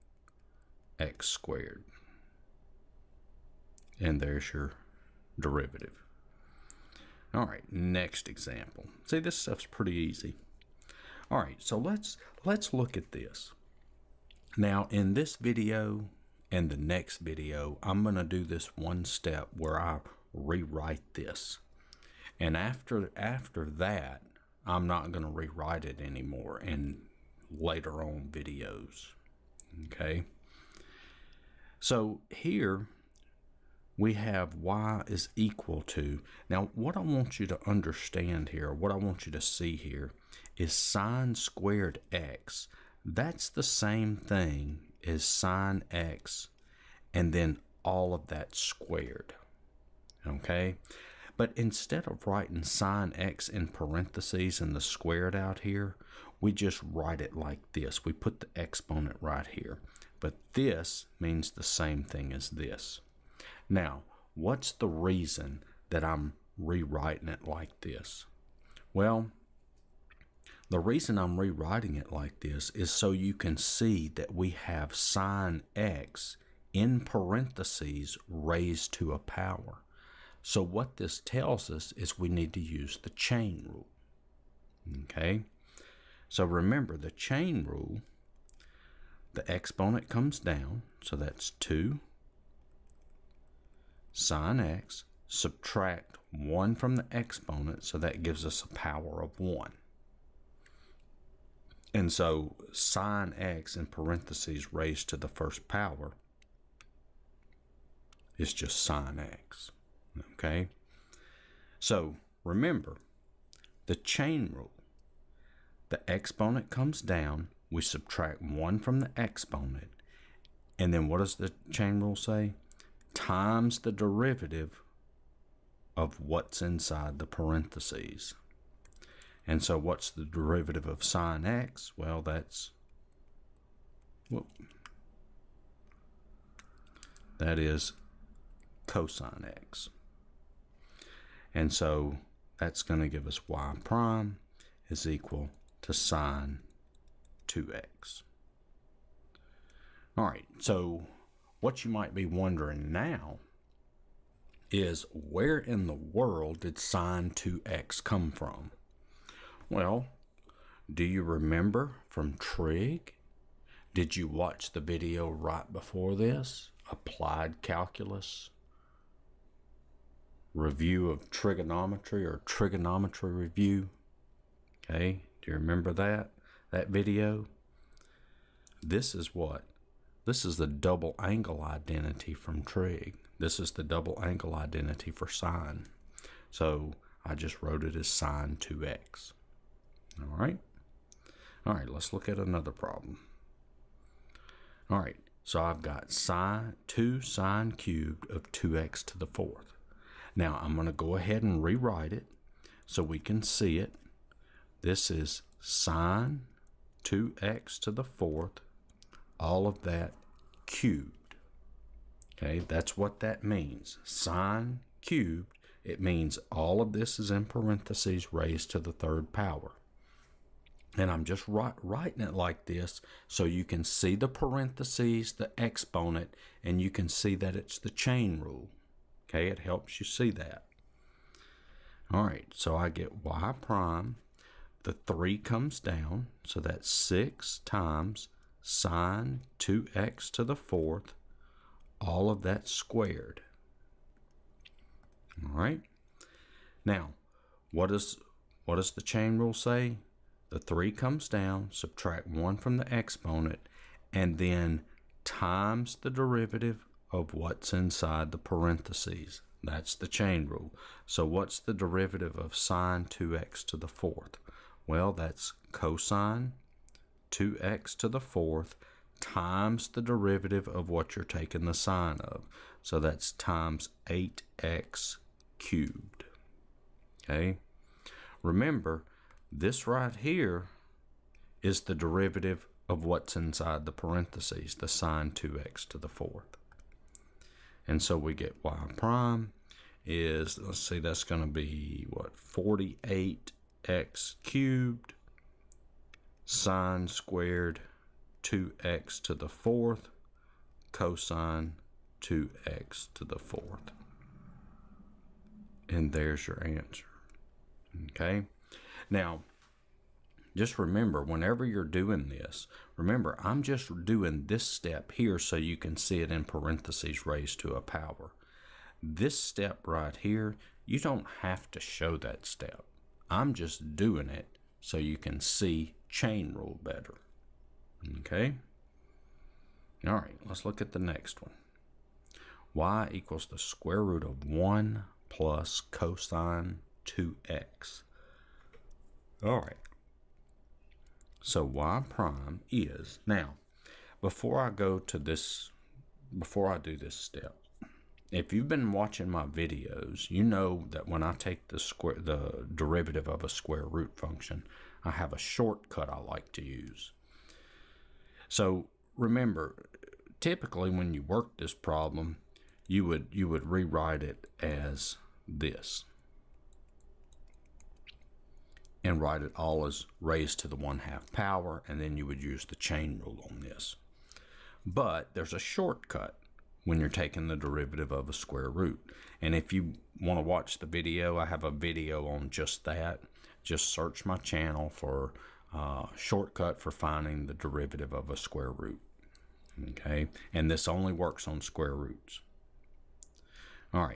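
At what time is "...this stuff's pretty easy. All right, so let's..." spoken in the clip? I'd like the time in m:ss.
0:09.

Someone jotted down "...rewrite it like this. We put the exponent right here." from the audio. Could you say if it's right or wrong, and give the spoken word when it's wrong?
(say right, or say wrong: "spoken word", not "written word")
wrong: "write", not "rewrite".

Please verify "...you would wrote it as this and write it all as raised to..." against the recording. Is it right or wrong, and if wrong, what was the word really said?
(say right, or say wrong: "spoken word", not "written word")
wrong: "rewrite", not "wrote".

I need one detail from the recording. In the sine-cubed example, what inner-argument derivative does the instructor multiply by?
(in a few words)
8x cubed.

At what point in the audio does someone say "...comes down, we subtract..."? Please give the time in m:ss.
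1:56.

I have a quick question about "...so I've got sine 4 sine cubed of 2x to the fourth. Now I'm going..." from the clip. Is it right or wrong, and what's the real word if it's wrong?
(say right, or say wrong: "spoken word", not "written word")
wrong: "2", not "4".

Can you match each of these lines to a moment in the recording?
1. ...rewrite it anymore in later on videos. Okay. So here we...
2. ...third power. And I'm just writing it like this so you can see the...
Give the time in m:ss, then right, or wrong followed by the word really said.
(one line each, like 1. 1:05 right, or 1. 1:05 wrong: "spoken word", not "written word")
1. 0:25 right
2. 3:38 right.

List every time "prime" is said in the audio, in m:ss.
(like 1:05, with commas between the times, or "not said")
2:23, 3:53, 4:48, 5:42.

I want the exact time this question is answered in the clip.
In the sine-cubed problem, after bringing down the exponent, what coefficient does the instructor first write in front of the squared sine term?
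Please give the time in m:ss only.
3:56.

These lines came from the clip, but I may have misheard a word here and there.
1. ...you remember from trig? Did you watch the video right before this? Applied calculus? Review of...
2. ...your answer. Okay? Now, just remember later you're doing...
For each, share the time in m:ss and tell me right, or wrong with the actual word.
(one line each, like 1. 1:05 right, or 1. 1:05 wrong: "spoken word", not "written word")
1. 2:41 right
2. 5:06 wrong: "whenever", not "later".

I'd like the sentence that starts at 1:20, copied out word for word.
So what this tells us is we need to use the chain rule.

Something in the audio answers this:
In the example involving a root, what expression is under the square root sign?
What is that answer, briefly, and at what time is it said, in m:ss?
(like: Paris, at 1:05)
1 plus cosine 2x, at 5:34.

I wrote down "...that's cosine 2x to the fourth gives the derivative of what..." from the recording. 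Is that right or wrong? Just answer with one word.
wrong.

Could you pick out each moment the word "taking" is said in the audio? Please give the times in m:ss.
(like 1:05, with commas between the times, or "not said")
4:31, 6:17.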